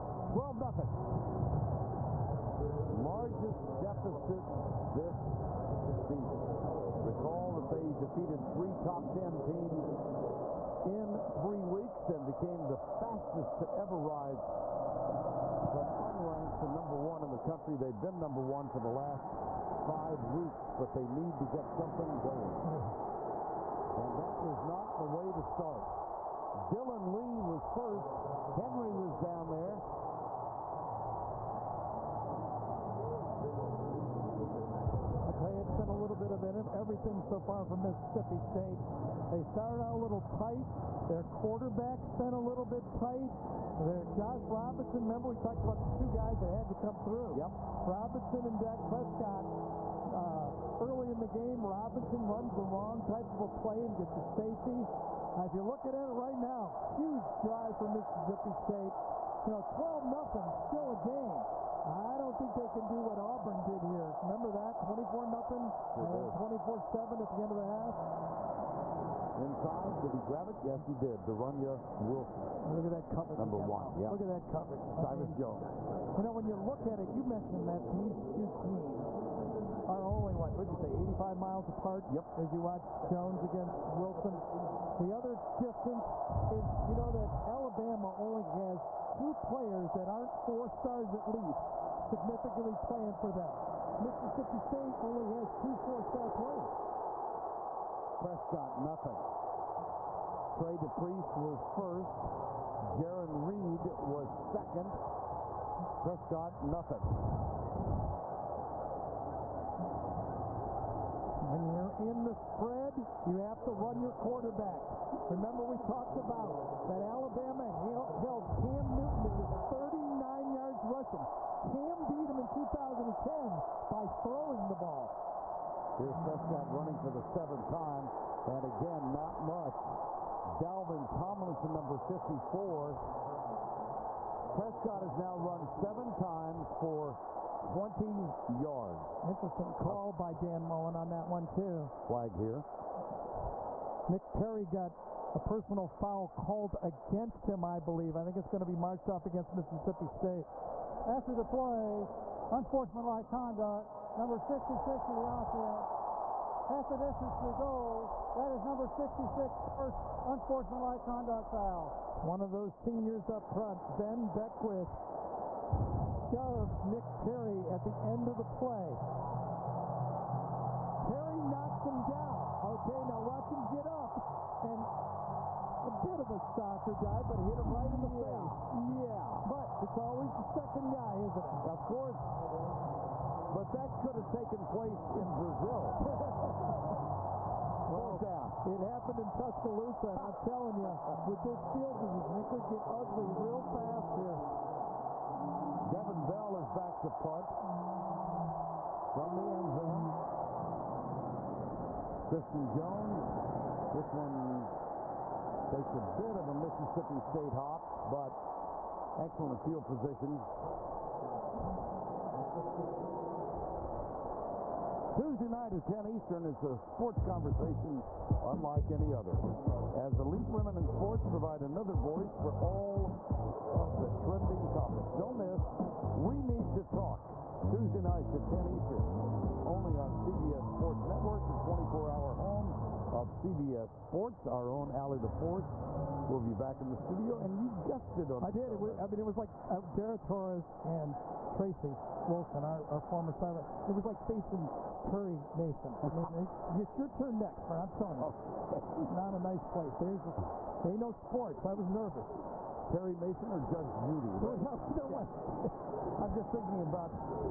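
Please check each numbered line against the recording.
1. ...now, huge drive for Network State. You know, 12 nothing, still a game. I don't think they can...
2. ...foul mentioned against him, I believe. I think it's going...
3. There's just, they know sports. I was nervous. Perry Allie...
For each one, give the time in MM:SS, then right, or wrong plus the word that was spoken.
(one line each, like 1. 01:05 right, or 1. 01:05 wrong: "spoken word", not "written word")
1. 00:56 wrong: "Mississippi", not "Network"
2. 02:25 wrong: "called", not "mentioned"
3. 04:09 wrong: "Mason", not "Allie".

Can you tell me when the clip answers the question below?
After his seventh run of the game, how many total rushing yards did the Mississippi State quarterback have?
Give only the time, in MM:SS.
02:17.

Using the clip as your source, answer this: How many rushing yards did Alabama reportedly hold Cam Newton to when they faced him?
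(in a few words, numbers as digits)
39.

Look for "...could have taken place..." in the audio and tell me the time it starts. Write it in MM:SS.
03:04.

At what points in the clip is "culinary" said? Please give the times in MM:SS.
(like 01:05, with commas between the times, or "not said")
not said.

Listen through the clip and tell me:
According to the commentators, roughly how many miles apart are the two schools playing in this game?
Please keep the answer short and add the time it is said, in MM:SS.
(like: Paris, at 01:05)
85, at 01:20.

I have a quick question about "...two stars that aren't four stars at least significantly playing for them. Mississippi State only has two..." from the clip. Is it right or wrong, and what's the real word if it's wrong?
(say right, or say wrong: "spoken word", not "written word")
wrong: "players", not "stars".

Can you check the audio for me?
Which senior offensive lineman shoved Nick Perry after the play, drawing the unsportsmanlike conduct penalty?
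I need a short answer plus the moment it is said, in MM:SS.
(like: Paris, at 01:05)
Ben Beckwith, at 02:43.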